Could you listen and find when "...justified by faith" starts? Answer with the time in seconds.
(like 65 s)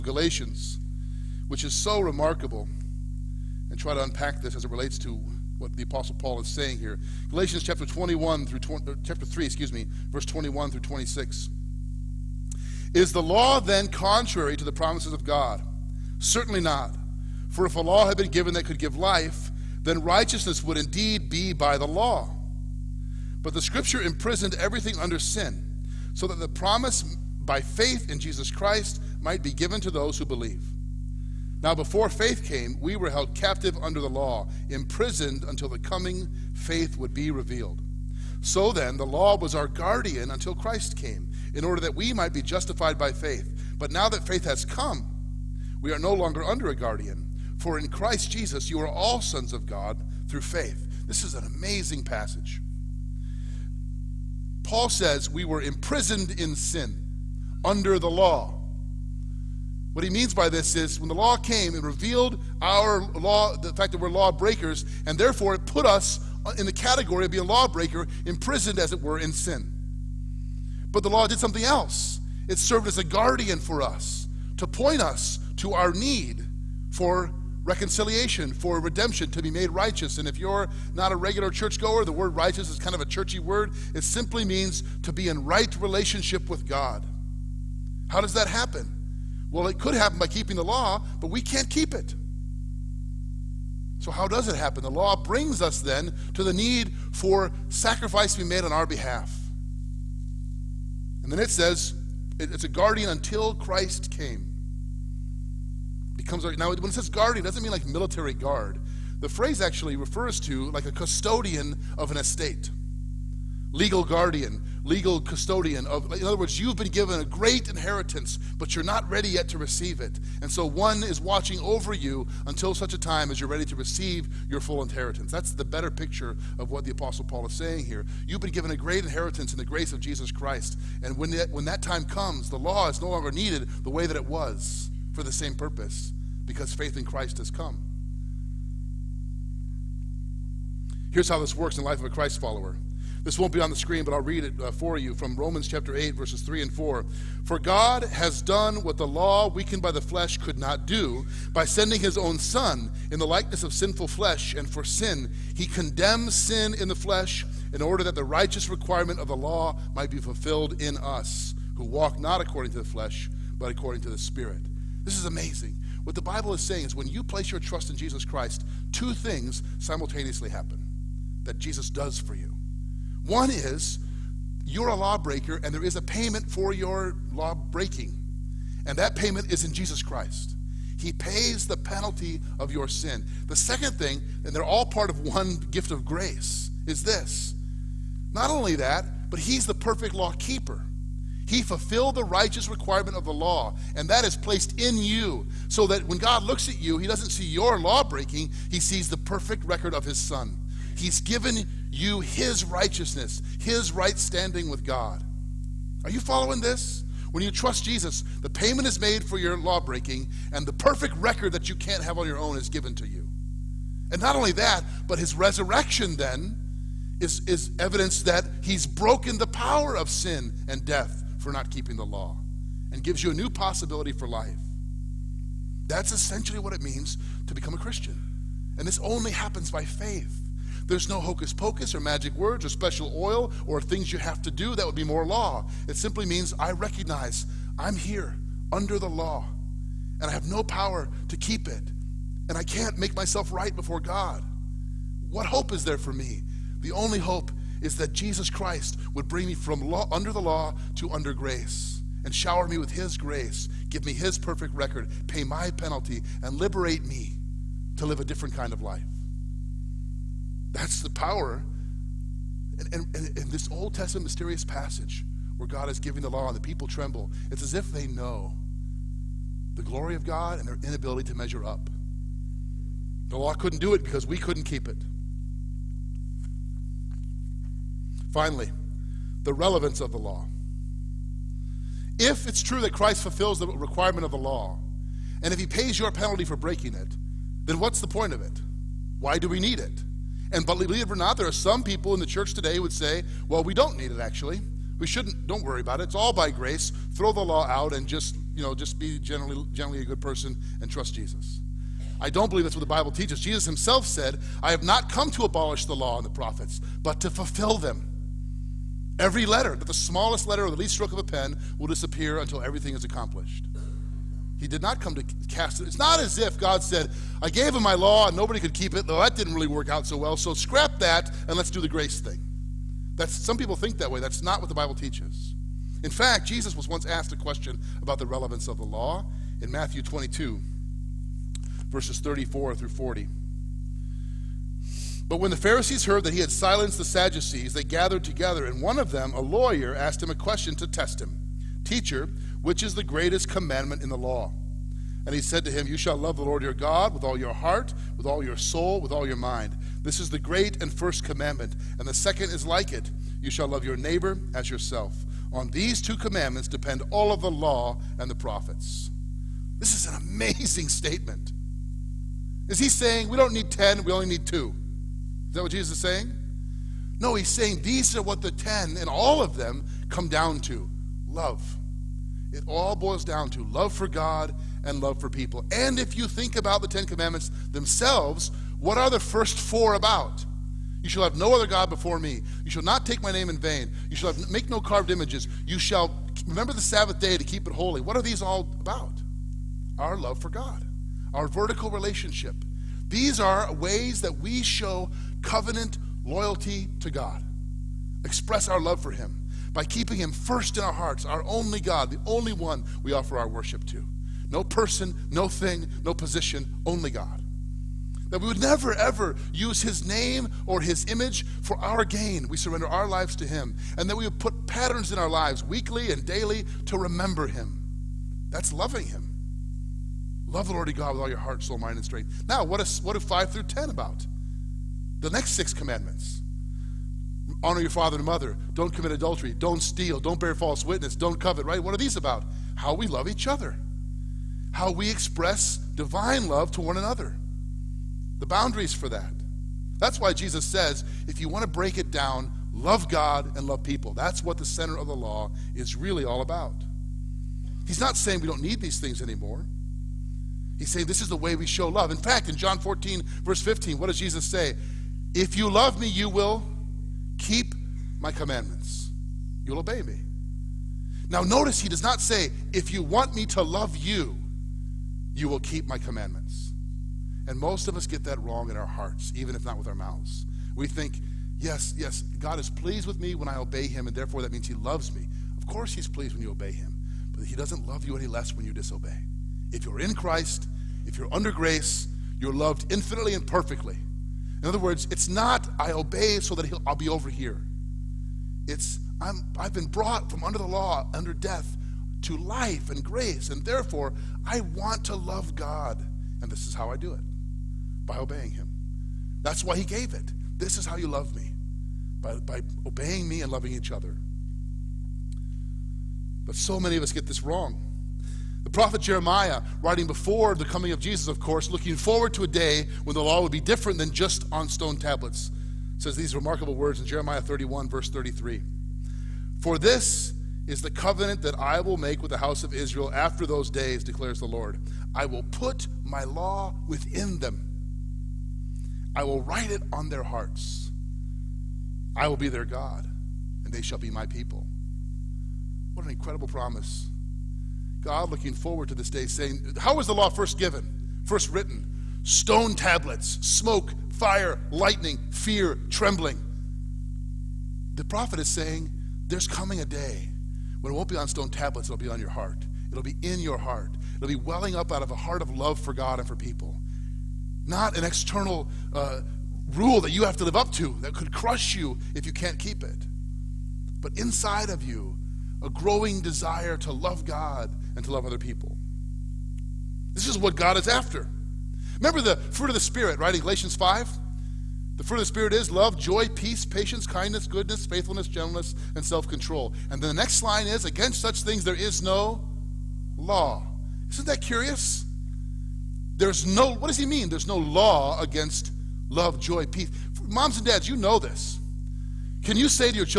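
42 s.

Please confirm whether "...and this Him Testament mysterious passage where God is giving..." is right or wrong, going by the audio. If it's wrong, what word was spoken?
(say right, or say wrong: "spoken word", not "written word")
wrong: "Old", not "Him".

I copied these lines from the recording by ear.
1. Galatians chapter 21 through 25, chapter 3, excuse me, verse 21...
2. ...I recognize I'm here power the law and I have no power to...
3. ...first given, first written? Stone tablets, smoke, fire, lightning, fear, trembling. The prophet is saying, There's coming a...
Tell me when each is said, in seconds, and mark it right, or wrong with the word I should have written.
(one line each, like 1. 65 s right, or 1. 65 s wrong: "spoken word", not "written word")
1. 7 s wrong: "20", not "25"
2. 236 s wrong: "under", not "power"
3. 540 s right.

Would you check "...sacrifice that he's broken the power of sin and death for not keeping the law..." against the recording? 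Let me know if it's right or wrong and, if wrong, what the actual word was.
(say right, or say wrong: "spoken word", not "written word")
wrong: "evidence", not "sacrifice".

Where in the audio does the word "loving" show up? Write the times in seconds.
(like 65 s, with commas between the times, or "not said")
418 s, 503 s.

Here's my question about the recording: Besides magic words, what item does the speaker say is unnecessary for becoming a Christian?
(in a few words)
special oil.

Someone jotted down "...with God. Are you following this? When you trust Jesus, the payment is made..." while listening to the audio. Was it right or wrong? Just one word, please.
right.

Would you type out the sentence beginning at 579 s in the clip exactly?
And then the next line is against such things there is no law.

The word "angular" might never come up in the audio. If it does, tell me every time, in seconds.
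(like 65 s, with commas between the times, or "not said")
not said.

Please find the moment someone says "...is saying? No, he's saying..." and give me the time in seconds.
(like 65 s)
365 s.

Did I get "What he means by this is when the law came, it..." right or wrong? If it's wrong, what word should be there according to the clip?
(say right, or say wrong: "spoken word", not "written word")
right.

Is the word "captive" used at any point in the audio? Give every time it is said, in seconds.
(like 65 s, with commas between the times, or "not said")
33 s.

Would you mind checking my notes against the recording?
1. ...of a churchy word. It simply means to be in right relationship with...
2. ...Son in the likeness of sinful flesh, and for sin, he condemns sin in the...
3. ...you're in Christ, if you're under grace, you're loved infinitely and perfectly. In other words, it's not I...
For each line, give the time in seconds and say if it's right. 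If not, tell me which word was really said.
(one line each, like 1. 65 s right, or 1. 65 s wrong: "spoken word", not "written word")
1. 82 s right
2. 152 s right
3. 479 s right.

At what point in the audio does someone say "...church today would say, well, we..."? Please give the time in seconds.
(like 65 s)
292 s.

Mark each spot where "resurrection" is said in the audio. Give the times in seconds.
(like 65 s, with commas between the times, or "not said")
215 s.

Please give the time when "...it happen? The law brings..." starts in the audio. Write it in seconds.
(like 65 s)
94 s.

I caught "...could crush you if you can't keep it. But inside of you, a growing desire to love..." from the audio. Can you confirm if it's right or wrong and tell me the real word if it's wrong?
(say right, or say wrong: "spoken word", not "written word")
right.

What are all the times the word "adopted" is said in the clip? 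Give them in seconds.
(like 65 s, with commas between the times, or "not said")
not said.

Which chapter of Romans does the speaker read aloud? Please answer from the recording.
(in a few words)
8.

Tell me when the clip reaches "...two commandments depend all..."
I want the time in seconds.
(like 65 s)
356 s.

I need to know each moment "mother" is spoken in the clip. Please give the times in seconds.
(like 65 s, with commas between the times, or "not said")
428 s.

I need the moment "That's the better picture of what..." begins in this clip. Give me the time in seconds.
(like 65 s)
125 s.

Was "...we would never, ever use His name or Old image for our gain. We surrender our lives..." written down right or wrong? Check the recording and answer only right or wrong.
wrong.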